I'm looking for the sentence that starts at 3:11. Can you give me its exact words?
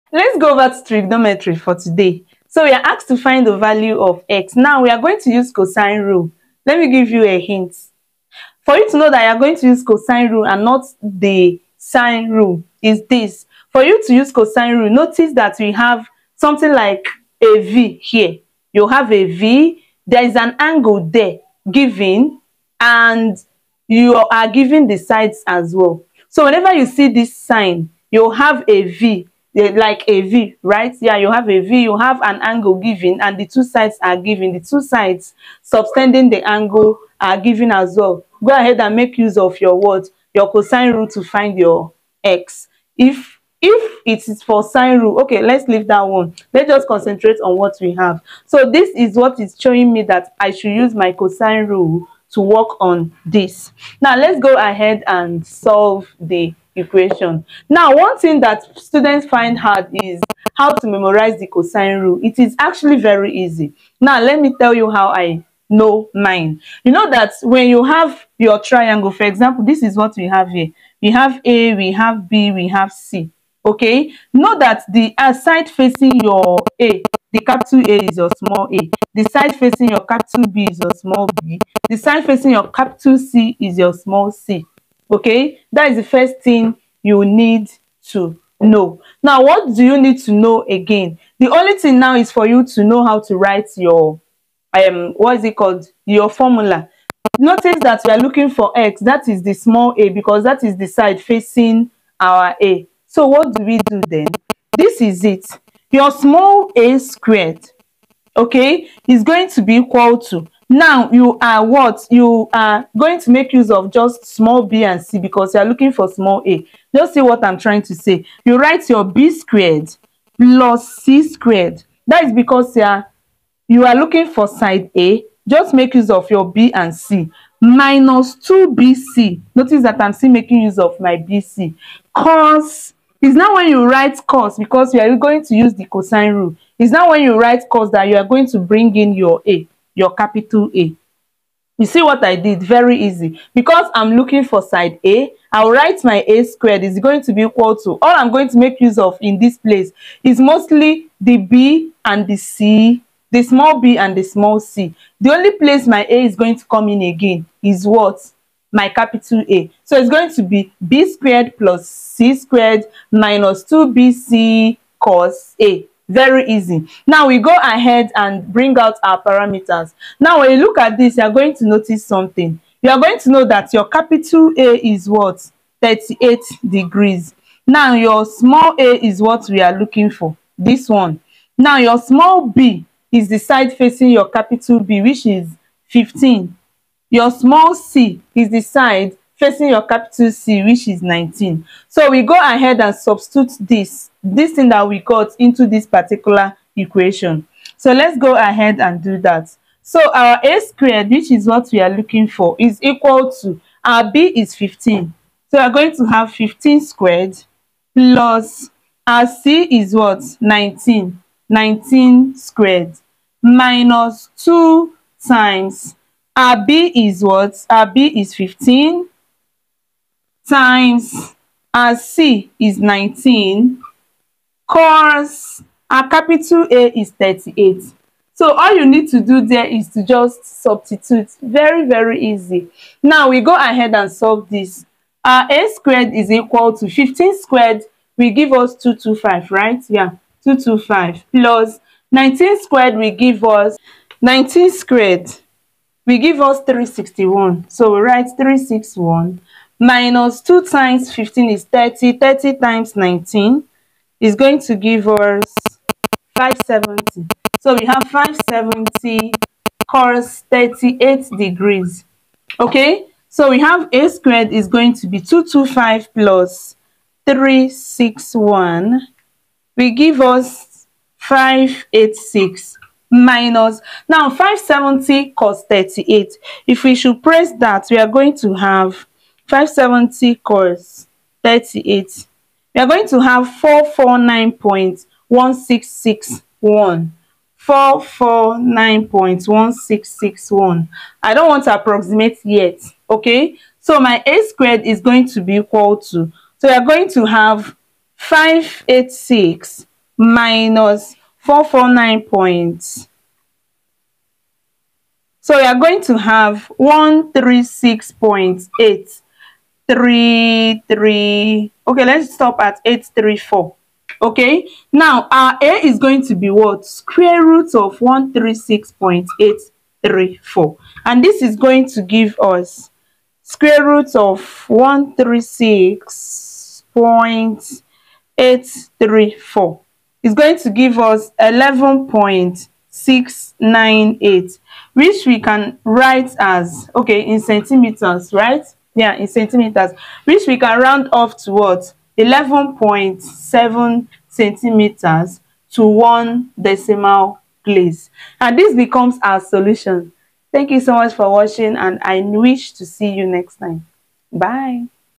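So we go ahead and substitute this, this thing that we got into this particular equation.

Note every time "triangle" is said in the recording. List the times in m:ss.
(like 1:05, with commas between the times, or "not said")
1:08.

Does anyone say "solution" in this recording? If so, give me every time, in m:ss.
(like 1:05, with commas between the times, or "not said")
5:49.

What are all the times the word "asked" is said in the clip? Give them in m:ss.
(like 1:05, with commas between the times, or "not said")
0:02.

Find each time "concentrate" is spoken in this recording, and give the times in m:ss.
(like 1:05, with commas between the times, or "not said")
0:46.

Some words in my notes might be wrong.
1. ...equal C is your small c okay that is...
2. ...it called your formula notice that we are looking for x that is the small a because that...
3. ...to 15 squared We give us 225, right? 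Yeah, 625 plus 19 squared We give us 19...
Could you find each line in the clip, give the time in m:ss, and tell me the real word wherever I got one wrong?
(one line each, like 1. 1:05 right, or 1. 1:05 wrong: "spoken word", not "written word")
1. 1:22 wrong: "capital", not "equal"
2. 1:35 right
3. 3:56 wrong: "225", not "625".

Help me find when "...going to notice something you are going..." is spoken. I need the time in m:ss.
2:51.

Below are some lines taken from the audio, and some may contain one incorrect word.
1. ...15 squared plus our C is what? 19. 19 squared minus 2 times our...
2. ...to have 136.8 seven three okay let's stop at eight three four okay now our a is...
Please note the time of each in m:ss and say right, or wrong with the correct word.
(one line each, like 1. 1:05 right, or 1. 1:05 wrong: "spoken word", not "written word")
1. 3:26 right
2. 5:06 wrong: "three", not "seven".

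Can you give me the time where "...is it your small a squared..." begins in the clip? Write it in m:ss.
1:45.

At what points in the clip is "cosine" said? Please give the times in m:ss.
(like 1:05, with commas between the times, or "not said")
0:05, 0:09, 0:14, 0:40, 0:51, 1:01, 2:15.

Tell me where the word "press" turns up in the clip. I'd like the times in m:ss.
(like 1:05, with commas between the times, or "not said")
4:37.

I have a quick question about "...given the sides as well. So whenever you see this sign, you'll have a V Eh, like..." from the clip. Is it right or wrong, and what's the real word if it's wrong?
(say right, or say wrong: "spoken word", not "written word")
right.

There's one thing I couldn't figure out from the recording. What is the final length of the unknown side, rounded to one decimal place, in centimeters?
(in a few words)
11.7 cm.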